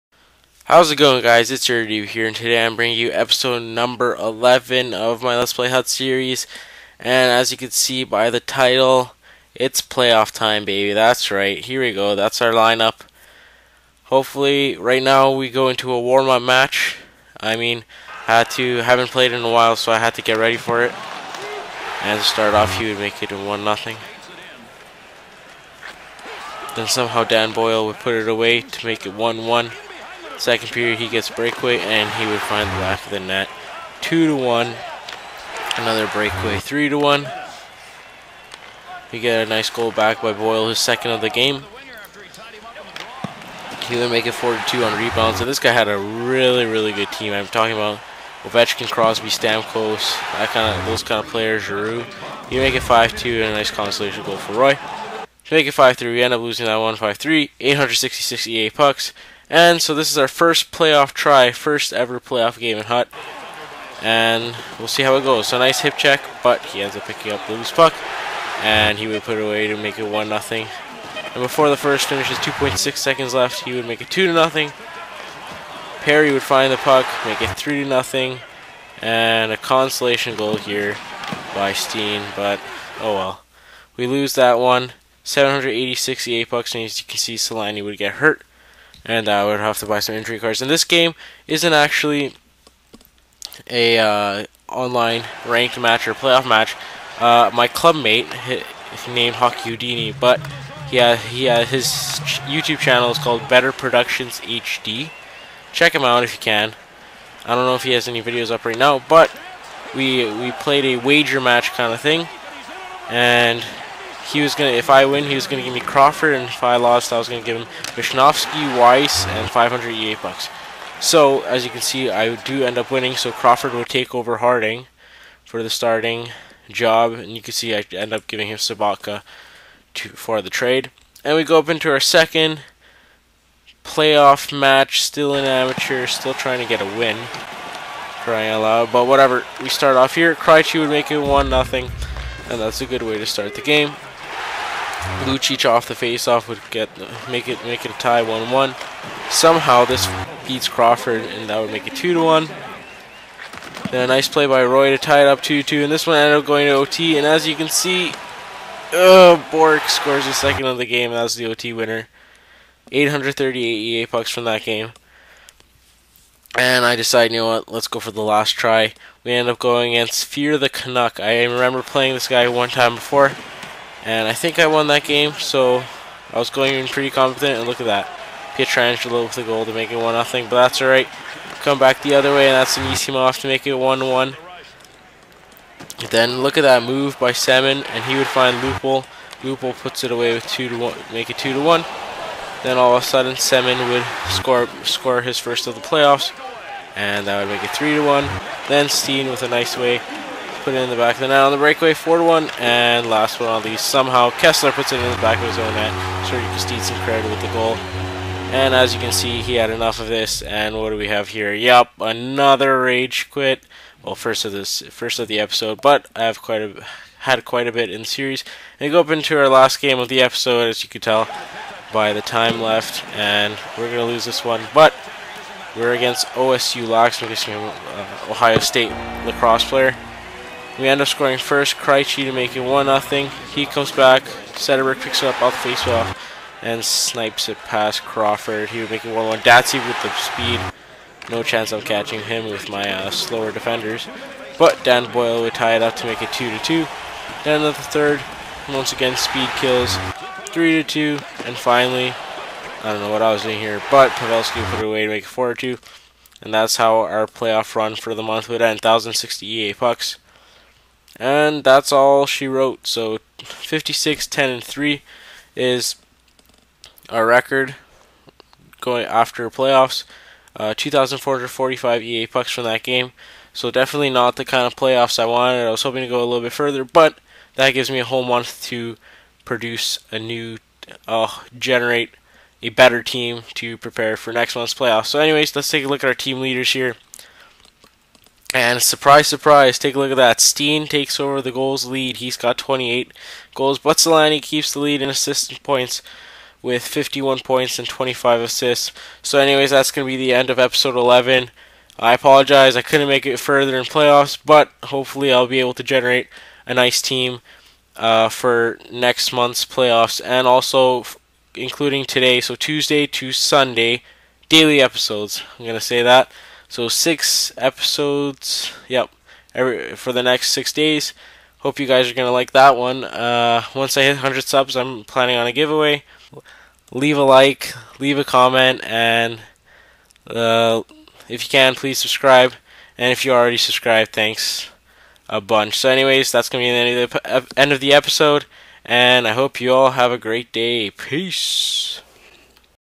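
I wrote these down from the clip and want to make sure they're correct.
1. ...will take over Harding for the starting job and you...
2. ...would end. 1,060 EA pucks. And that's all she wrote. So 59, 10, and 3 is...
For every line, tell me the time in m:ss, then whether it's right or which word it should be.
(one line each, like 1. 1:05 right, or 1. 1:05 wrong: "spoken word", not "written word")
1. 2:03 right
2. 4:18 wrong: "56", not "59".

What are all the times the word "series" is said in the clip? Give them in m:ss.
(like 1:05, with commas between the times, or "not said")
0:05, 3:38.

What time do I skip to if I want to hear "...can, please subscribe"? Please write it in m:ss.
5:31.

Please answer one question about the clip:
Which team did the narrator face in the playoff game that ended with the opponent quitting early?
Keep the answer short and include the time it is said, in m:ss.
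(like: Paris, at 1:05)
Fear the Canuck, at 2:50.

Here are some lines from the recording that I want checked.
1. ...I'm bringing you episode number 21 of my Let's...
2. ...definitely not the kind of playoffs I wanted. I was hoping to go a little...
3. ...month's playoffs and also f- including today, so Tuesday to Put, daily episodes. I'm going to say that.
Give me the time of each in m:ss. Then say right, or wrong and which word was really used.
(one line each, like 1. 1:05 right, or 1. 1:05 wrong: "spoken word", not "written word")
1. 0:02 wrong: "11", not "21"
2. 4:33 right
3. 5:09 wrong: "Sunday", not "Put".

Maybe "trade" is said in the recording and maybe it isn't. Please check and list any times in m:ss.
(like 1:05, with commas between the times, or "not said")
2:10.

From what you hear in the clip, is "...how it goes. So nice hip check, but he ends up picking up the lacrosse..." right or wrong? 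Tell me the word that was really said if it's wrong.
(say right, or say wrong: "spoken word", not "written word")
wrong: "loose", not "lacrosse".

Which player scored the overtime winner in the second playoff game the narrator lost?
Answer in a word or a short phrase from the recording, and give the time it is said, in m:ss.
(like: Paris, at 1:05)
Bork, at 2:39.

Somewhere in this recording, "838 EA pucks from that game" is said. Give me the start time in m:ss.
2:42.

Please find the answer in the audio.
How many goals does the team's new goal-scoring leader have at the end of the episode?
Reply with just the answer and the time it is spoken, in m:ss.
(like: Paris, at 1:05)
28, at 4:52.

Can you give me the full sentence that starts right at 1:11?
And before the first finishes, 2.6 seconds left, he would make it 2 to nothing.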